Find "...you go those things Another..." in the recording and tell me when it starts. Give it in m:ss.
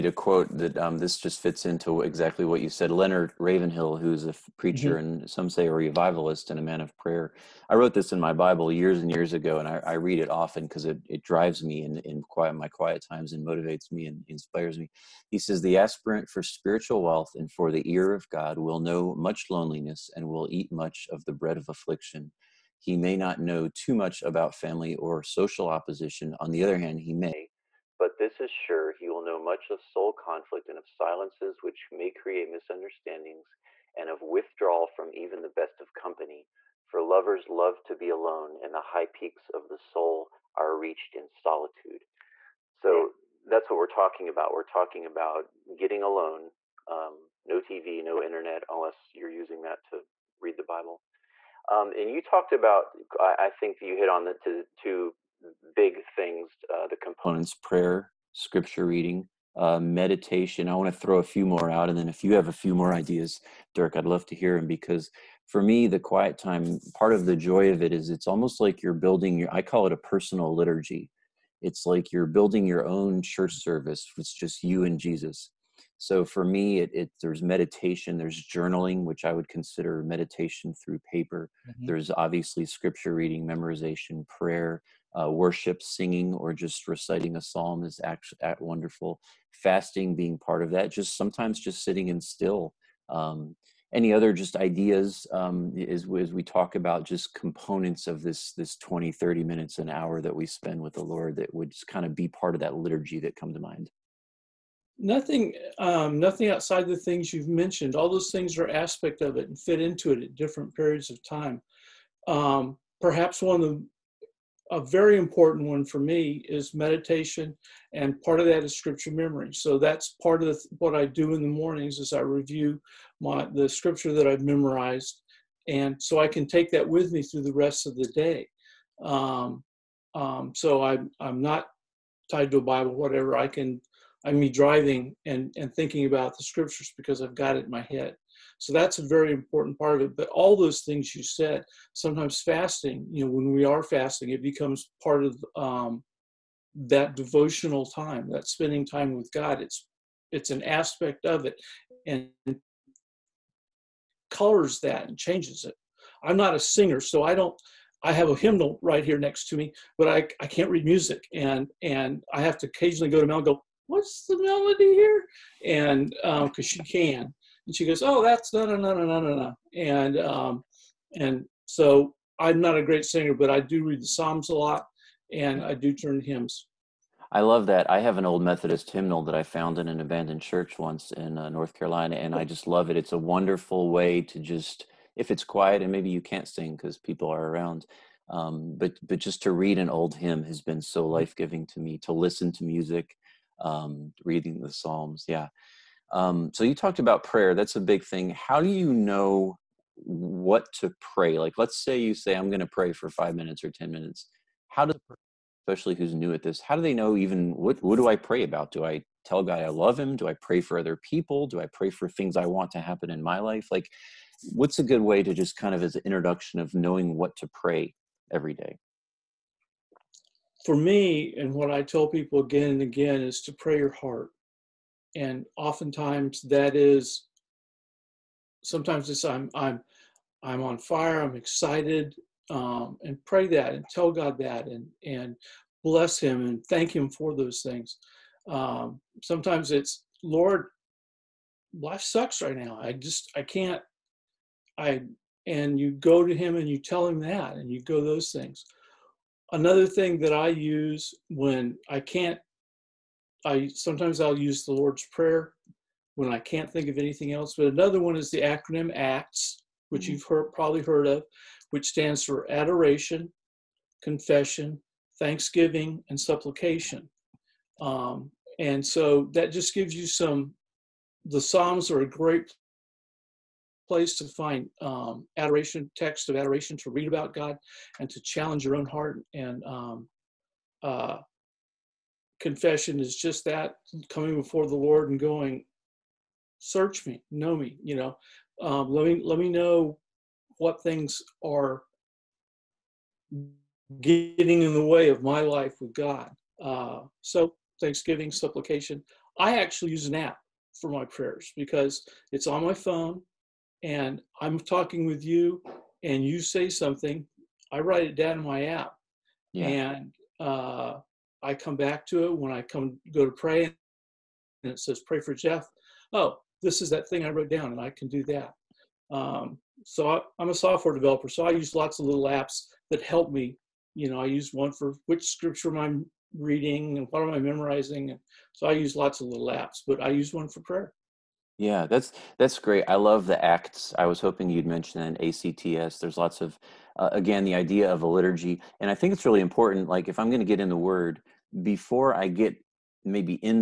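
4:07.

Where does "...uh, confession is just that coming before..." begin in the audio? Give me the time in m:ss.
4:40.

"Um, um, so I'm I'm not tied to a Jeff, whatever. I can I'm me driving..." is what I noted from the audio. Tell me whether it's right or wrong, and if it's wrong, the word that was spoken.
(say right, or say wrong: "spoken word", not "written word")
wrong: "Bible", not "Jeff".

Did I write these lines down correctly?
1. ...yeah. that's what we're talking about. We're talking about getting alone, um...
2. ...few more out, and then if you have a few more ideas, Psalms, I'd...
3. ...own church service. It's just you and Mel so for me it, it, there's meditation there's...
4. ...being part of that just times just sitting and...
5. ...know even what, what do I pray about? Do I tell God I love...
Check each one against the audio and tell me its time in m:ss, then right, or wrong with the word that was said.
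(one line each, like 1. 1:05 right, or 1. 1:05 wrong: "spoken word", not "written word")
1. 0:42 right
2. 1:01 wrong: "Dirk", not "Psalms"
3. 1:12 wrong: "Jesus", not "Mel"
4. 1:30 wrong: "sometimes", not "times"
5. 3:26 right.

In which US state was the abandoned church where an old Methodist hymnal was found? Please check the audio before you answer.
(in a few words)
North Carolina.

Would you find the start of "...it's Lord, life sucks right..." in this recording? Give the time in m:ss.
3:59.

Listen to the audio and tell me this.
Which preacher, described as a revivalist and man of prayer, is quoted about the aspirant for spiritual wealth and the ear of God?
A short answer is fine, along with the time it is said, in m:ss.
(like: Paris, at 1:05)
Leonard Ravenhill, at 0:02.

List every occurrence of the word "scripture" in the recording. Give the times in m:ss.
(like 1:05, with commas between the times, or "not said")
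0:58, 1:22, 1:58, 2:03, 2:16, 5:25.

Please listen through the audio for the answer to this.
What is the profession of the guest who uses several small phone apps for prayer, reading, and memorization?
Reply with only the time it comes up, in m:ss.
5:20.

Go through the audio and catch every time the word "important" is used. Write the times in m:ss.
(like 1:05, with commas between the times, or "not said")
1:55, 2:19, 5:39.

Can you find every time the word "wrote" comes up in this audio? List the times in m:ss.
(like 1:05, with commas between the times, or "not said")
0:07, 5:17.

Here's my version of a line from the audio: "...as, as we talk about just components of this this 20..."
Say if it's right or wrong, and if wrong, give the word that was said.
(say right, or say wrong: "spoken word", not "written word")
right.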